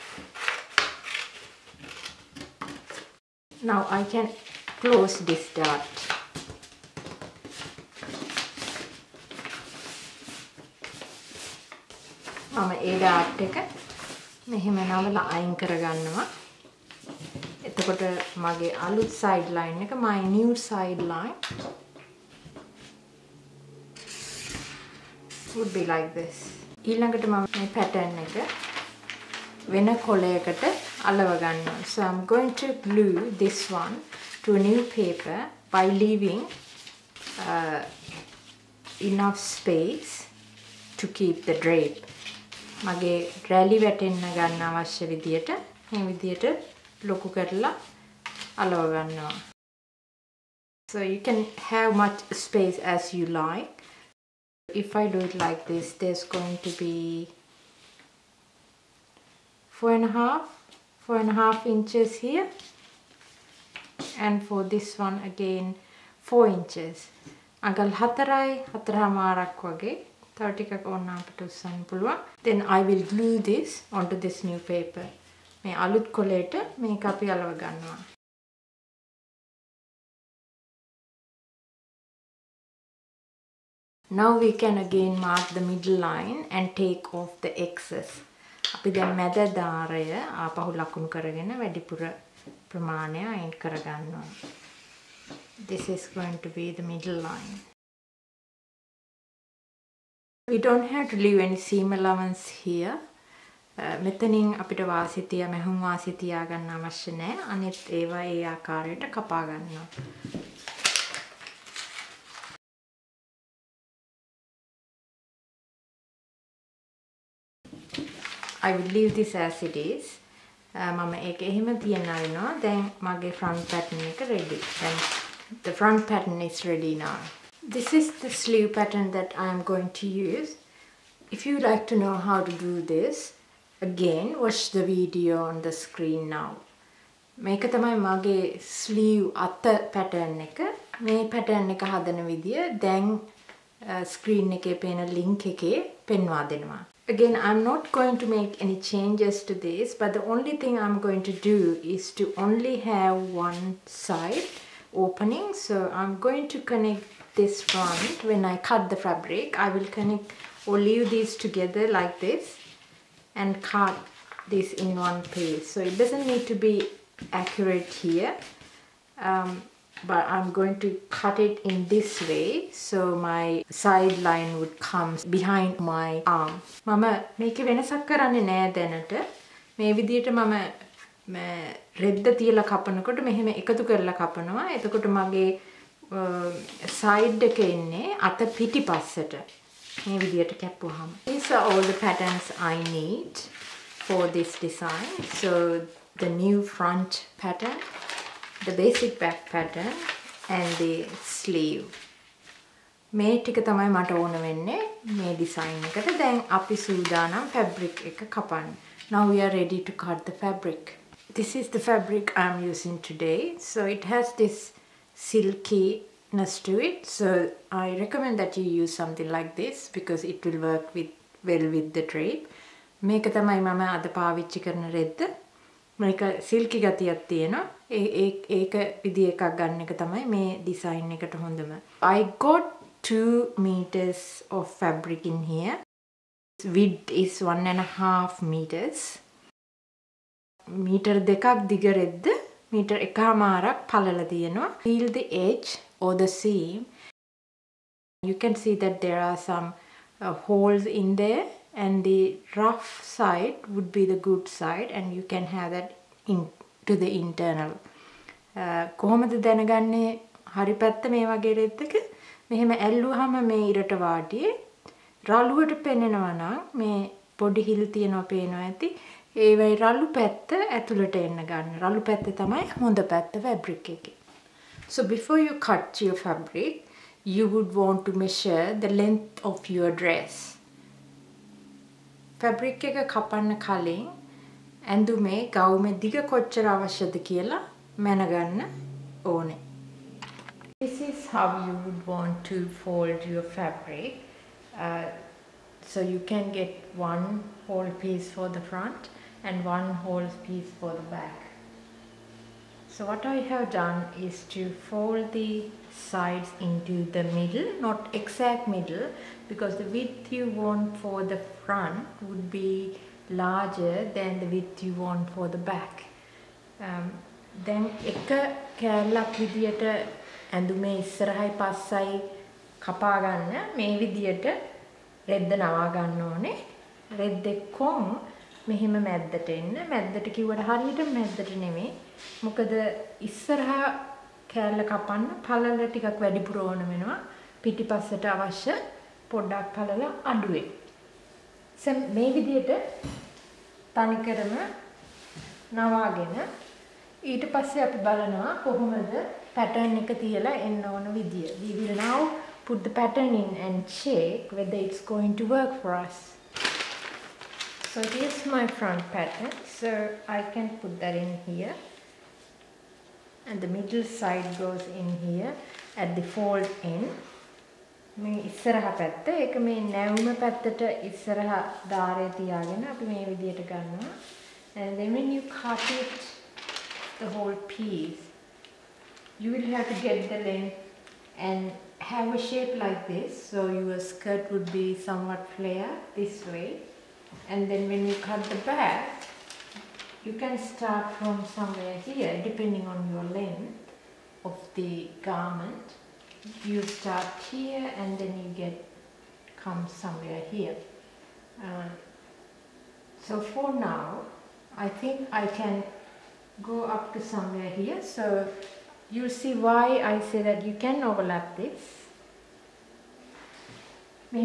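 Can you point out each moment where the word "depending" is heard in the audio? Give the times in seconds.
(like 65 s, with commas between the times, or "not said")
392 s.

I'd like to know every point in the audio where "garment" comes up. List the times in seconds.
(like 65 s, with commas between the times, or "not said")
395 s.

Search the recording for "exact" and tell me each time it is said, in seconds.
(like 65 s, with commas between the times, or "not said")
308 s.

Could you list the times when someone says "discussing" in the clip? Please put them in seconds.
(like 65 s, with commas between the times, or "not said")
not said.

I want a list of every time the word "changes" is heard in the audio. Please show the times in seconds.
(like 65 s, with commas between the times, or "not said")
148 s.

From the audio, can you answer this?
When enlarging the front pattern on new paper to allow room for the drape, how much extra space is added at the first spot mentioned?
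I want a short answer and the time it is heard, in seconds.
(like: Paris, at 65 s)
4 and a half inches, at 61 s.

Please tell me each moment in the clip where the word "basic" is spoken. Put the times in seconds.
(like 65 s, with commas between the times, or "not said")
198 s.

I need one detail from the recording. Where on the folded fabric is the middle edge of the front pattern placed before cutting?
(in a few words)
at the fold end.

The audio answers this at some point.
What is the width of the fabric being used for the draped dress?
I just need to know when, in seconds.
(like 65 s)
237 s.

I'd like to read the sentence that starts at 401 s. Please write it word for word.
Uh, so for now, I think I can go up to somewhere here.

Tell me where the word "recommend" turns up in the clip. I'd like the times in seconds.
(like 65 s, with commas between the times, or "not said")
218 s.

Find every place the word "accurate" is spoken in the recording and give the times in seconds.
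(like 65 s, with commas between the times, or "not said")
167 s.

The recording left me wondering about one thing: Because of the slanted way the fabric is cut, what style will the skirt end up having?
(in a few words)
somewhat flare.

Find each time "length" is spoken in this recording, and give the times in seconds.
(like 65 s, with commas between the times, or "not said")
279 s, 380 s, 393 s.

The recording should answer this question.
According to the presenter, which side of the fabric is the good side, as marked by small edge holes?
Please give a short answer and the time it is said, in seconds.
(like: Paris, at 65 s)
the rough side, at 252 s.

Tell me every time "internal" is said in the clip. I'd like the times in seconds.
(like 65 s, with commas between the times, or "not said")
257 s.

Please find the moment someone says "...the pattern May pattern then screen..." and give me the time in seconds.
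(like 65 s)
140 s.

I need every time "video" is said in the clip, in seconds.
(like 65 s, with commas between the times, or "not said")
134 s.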